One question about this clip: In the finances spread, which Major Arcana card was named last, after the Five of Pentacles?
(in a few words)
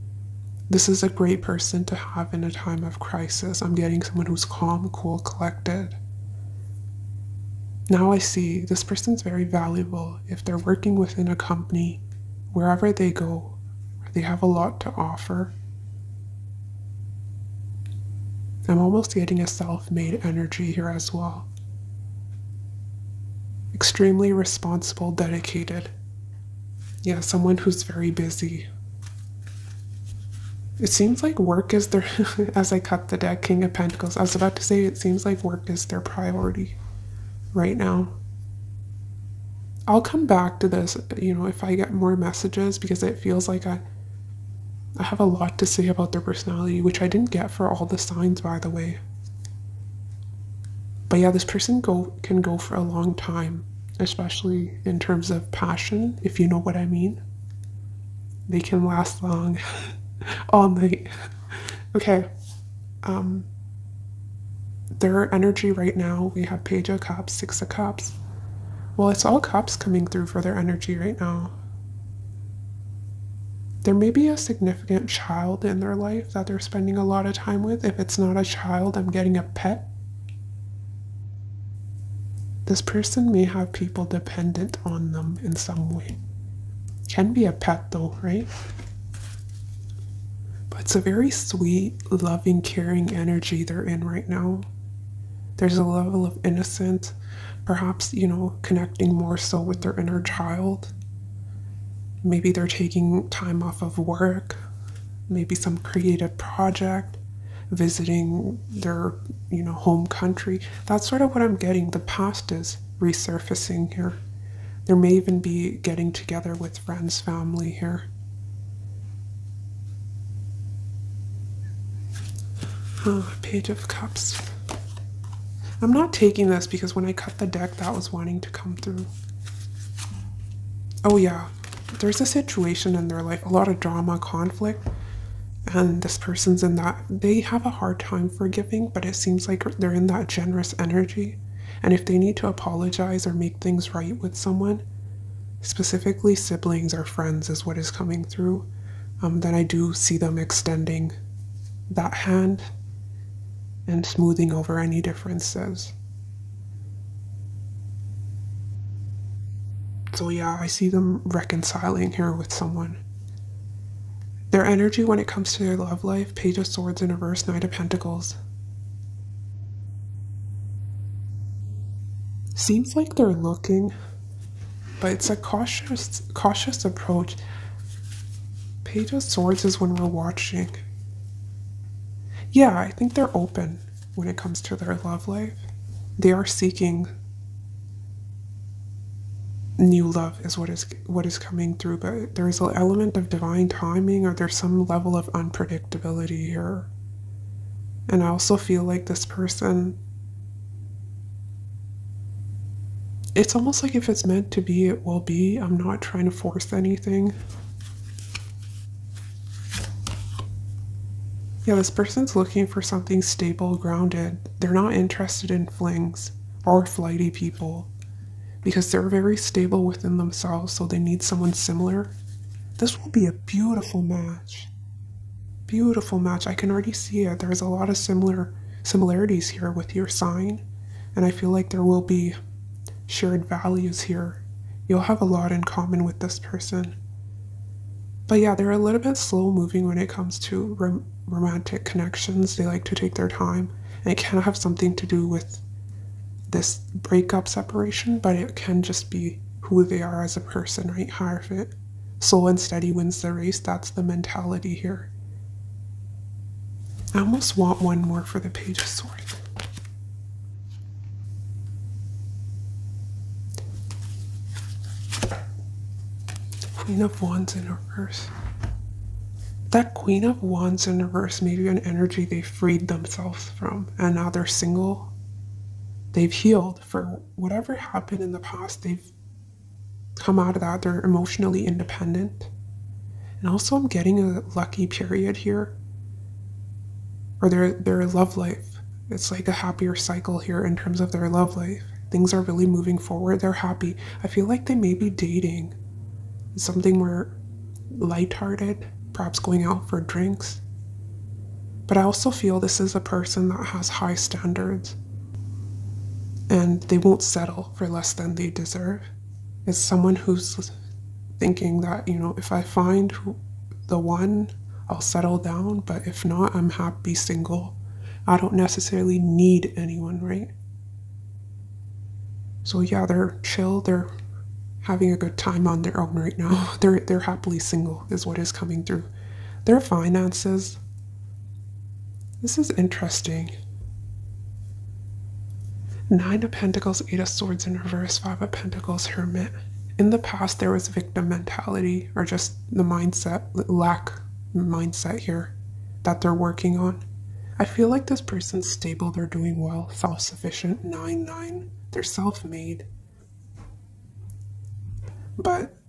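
Hermit.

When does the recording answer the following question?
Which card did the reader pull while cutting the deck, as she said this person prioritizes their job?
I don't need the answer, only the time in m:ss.
0:33.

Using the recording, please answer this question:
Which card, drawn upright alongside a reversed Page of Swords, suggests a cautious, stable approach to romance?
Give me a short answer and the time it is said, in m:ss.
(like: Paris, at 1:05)
Knight of Pentacles, at 2:47.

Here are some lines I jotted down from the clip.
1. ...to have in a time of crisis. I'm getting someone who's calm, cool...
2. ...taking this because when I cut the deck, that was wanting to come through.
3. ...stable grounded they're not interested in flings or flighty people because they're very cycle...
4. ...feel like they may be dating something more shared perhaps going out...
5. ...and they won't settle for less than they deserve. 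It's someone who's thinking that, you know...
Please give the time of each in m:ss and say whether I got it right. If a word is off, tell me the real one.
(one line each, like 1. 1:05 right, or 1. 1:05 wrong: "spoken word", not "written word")
1. 0:01 right
2. 2:06 right
3. 3:33 wrong: "stable", not "cycle"
4. 4:54 wrong: "hearted", not "shared"
5. 5:06 right.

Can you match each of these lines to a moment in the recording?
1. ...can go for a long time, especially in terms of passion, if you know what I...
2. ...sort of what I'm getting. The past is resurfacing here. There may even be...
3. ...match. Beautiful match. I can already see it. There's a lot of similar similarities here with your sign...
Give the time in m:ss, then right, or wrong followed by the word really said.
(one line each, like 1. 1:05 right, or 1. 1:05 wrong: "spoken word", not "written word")
1. 0:52 right
2. 1:51 right
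3. 3:44 right.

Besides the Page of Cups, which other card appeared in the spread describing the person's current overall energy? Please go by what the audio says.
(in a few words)
Six of Cups.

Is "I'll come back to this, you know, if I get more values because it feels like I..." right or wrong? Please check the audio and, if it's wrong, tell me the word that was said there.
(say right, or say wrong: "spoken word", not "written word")
wrong: "messages", not "values".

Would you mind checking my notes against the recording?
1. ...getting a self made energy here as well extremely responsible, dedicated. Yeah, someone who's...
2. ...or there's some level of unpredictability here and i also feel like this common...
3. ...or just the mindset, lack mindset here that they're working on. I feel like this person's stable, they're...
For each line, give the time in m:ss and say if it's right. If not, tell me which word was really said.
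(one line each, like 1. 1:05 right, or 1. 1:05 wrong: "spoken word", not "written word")
1. 0:19 right
2. 3:14 wrong: "person", not "common"
3. 5:42 right.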